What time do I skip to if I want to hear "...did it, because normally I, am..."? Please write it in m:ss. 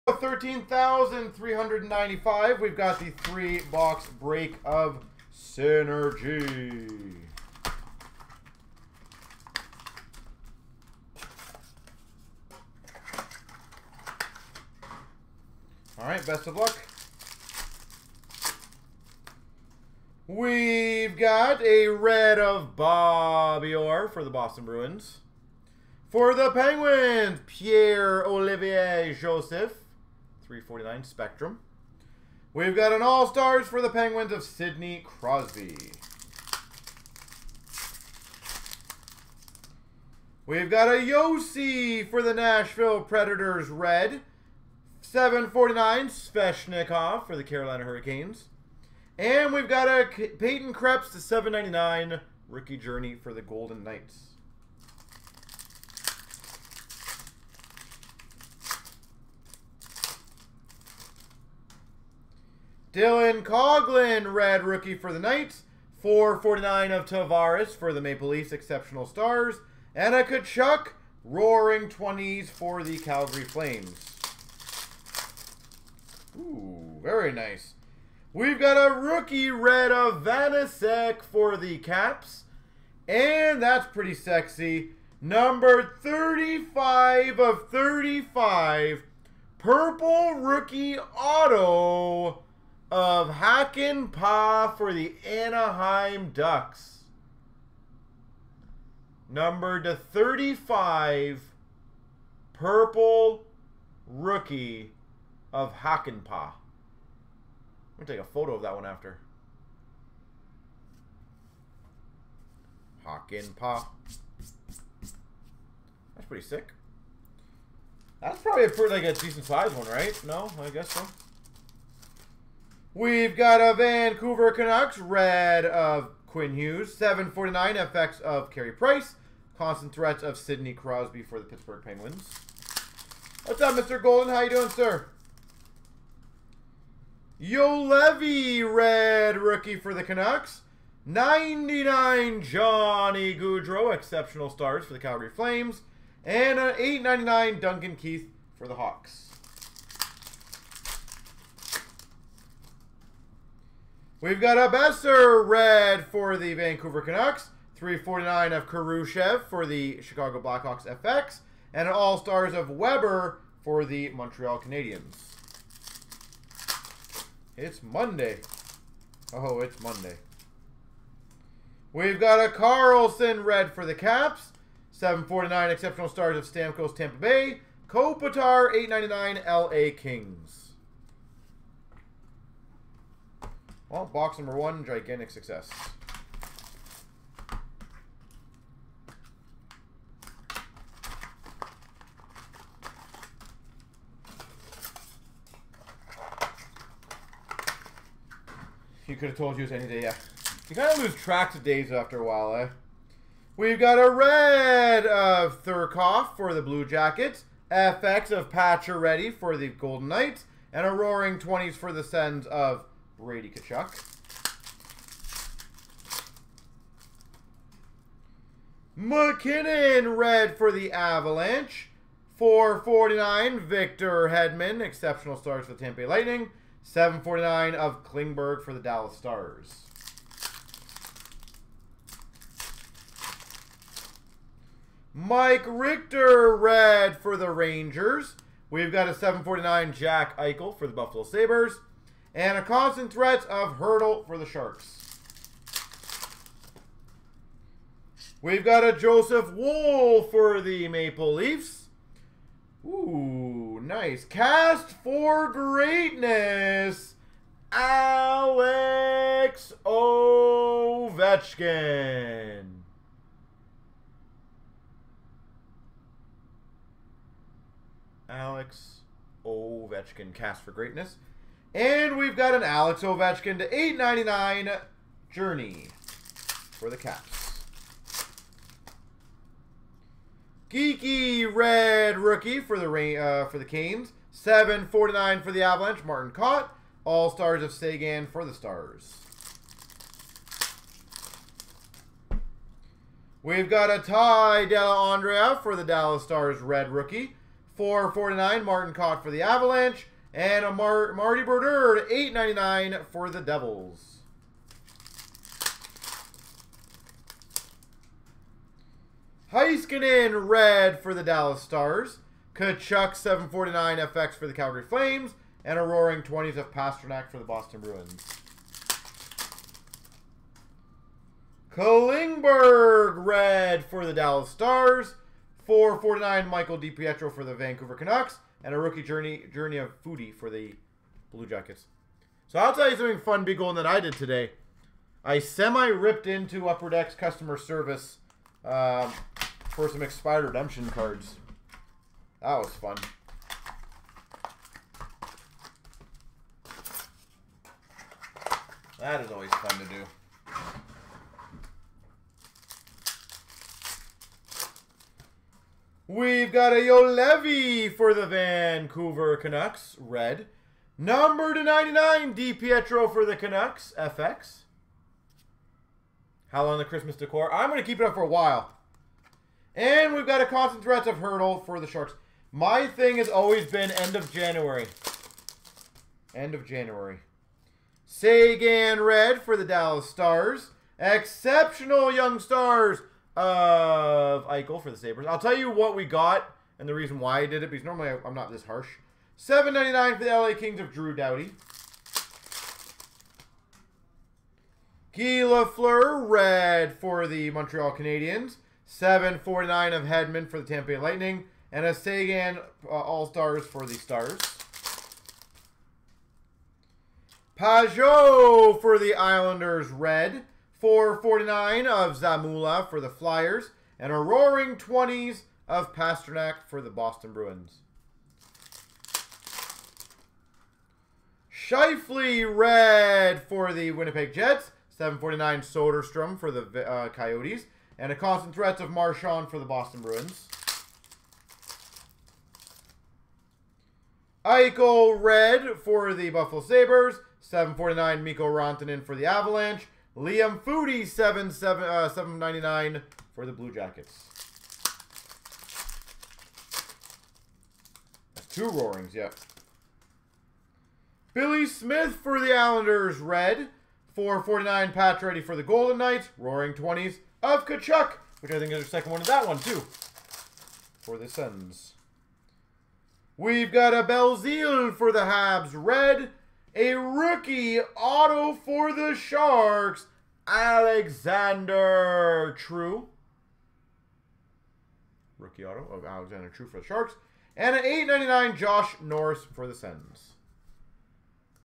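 6:27.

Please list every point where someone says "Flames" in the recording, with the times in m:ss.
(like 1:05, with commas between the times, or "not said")
1:13, 2:25, 5:14.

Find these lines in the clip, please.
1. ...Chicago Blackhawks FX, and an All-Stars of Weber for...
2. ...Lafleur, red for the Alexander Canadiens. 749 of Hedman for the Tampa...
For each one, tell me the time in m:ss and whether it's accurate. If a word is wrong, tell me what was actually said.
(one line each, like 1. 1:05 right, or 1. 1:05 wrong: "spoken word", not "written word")
1. 2:40 right
2. 6:35 wrong: "Montreal", not "Alexander".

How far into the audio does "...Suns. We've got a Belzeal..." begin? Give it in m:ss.
7:41.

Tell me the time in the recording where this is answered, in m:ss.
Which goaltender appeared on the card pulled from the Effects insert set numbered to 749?
2:08.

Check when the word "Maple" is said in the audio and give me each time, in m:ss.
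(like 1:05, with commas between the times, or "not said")
1:08, 4:10.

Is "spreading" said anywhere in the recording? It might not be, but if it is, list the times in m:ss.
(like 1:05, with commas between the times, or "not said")
not said.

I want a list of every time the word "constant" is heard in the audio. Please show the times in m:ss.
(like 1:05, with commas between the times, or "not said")
2:09, 4:02, 6:10, 7:08.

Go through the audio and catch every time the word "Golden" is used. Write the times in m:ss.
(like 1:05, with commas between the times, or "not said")
0:53, 2:14, 3:29, 5:33, 7:35.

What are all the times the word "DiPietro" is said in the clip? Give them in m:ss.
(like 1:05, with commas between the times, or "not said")
5:26, 6:02.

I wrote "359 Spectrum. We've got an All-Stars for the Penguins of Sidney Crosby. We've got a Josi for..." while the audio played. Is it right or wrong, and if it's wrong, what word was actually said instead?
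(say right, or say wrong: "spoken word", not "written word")
wrong: "349", not "359".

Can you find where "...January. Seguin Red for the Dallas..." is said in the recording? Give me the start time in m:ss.
6:16.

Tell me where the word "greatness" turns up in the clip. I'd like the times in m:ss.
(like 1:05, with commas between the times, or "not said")
4:15, 4:30.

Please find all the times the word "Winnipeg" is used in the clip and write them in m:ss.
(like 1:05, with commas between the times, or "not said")
7:03.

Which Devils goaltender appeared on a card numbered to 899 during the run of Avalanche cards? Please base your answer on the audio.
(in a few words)
Marty Brodeur.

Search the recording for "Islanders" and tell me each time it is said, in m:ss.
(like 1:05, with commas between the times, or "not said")
6:49, 7:32.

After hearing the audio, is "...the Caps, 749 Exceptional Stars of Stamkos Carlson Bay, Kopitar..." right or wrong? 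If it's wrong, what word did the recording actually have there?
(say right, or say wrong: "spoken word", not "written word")
wrong: "Tampa", not "Carlson".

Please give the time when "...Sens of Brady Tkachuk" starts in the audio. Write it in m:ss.
3:32.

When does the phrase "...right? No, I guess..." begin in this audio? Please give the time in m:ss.
1:59.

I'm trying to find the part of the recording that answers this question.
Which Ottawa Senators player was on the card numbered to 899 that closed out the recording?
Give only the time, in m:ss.
7:58.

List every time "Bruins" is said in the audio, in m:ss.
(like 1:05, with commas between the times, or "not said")
0:24, 5:17, 6:57, 7:10.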